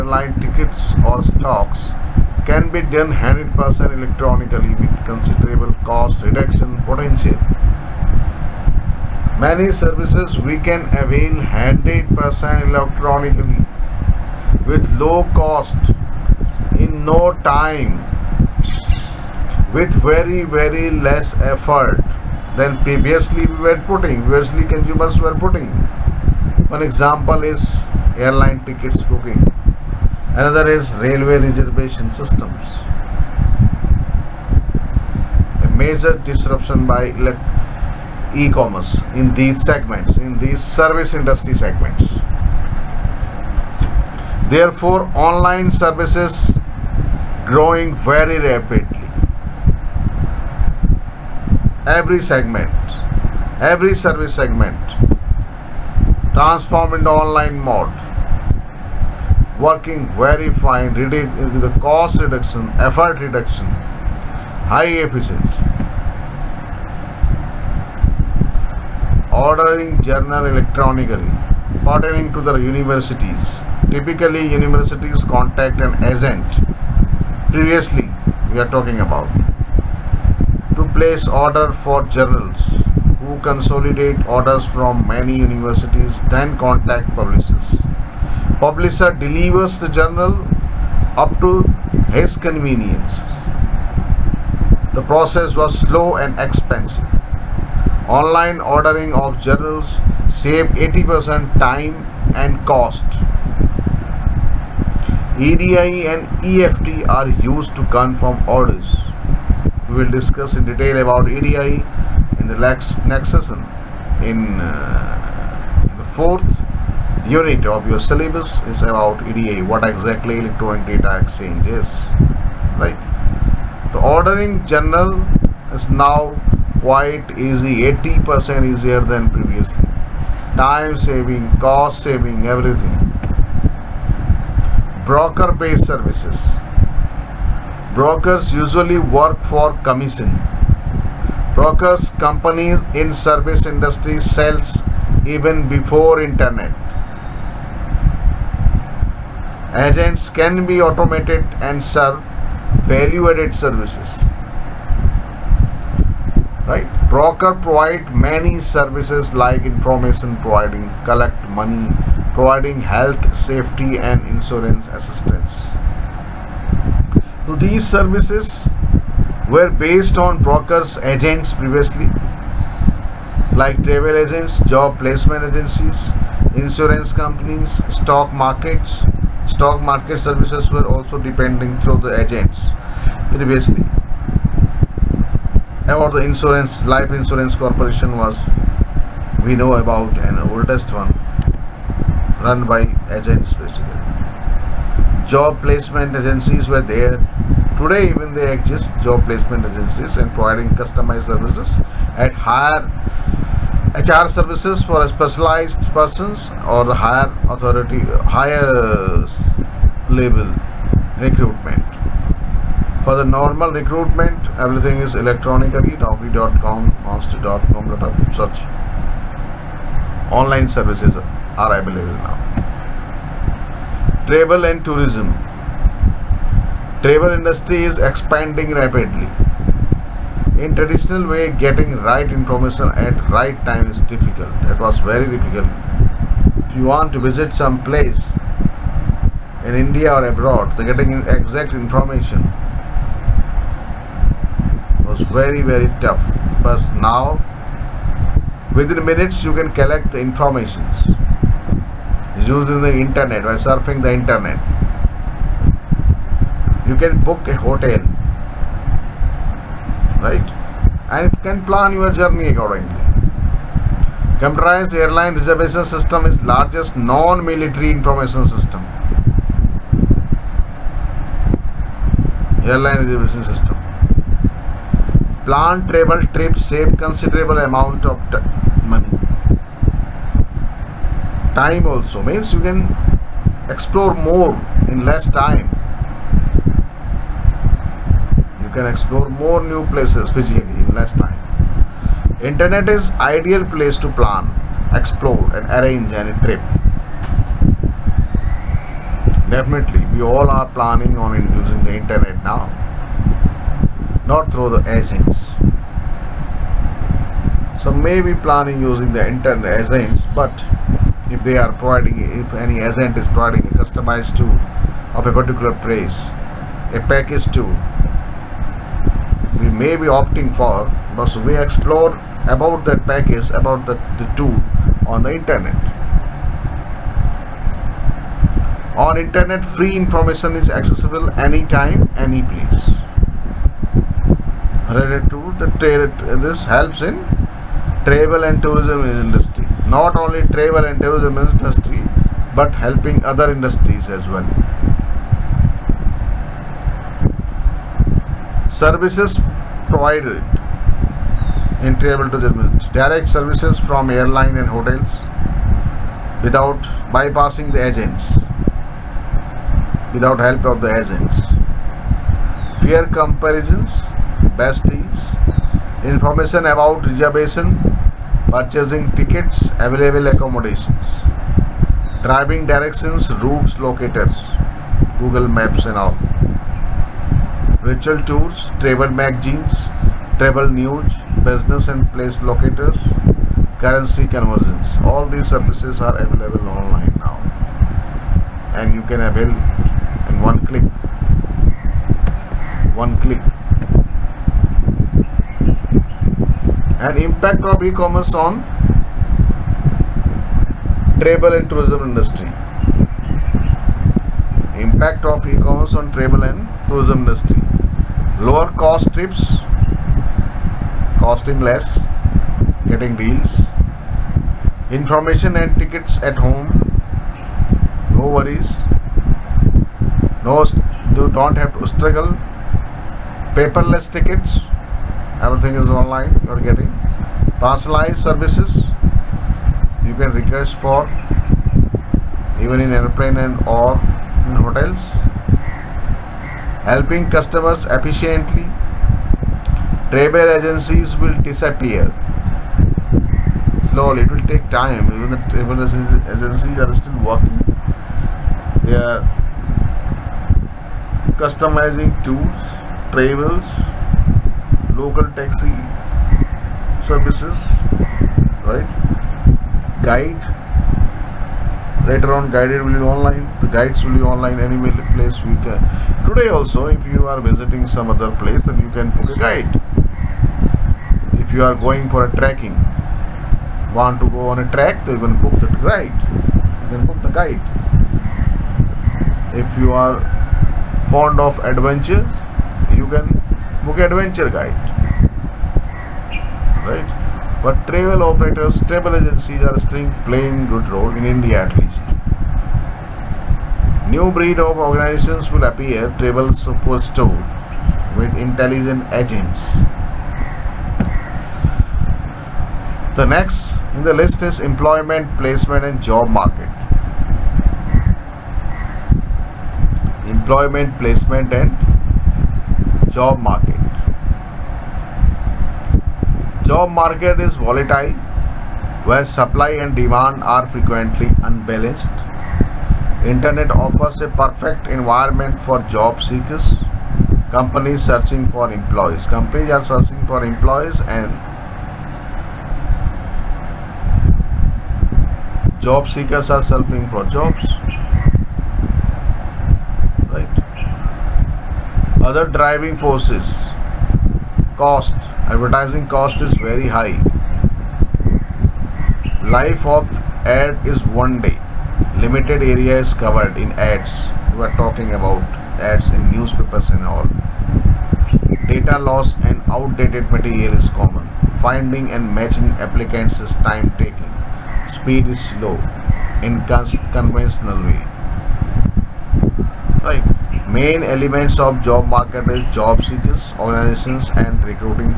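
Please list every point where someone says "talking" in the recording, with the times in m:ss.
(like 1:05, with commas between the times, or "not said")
1:18, 9:14.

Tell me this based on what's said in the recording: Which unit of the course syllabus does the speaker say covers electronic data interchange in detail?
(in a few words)
fourth unit.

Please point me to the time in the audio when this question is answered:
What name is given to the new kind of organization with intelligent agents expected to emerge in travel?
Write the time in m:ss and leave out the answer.
8:16.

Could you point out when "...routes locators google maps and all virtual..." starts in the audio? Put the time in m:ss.
6:13.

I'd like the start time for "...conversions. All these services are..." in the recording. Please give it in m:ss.
6:24.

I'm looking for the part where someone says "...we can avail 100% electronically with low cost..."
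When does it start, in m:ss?
0:10.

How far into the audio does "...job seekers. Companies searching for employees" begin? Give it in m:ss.
8:45.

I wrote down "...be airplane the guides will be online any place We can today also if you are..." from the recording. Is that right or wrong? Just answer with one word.
wrong.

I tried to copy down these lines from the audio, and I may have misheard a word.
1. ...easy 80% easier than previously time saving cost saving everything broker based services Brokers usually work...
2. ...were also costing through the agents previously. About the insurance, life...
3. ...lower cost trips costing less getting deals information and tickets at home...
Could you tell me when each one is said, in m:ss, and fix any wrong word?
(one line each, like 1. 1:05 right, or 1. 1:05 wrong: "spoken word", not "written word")
1. 2:07 right
2. 3:00 wrong: "depending", not "costing"
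3. 6:48 right.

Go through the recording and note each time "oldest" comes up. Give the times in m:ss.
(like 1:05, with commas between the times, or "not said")
3:10.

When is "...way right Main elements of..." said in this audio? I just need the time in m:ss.
9:27.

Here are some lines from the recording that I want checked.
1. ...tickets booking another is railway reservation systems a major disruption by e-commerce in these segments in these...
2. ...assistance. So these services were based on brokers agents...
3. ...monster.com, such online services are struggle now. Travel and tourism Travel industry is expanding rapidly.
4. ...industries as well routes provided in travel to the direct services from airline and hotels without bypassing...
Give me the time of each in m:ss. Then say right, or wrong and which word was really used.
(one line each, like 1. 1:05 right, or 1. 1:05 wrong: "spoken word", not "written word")
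1. 0:28 right
2. 2:44 right
3. 3:37 wrong: "available", not "struggle"
4. 5:43 wrong: "services", not "routes".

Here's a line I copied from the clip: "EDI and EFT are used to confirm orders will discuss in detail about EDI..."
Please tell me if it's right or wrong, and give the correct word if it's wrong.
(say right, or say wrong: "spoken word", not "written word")
right.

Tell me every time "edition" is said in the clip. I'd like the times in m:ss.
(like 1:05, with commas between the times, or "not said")
not said.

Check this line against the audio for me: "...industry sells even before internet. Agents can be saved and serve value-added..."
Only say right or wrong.
wrong.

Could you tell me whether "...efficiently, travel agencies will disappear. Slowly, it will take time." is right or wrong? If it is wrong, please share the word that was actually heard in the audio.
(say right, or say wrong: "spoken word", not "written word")
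right.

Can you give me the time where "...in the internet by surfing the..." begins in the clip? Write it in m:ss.
4:12.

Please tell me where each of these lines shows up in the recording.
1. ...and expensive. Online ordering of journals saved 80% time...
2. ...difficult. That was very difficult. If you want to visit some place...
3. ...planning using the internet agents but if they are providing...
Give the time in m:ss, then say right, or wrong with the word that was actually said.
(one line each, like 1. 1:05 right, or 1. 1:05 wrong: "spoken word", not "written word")
1. 1:36 right
2. 3:54 right
3. 5:08 right.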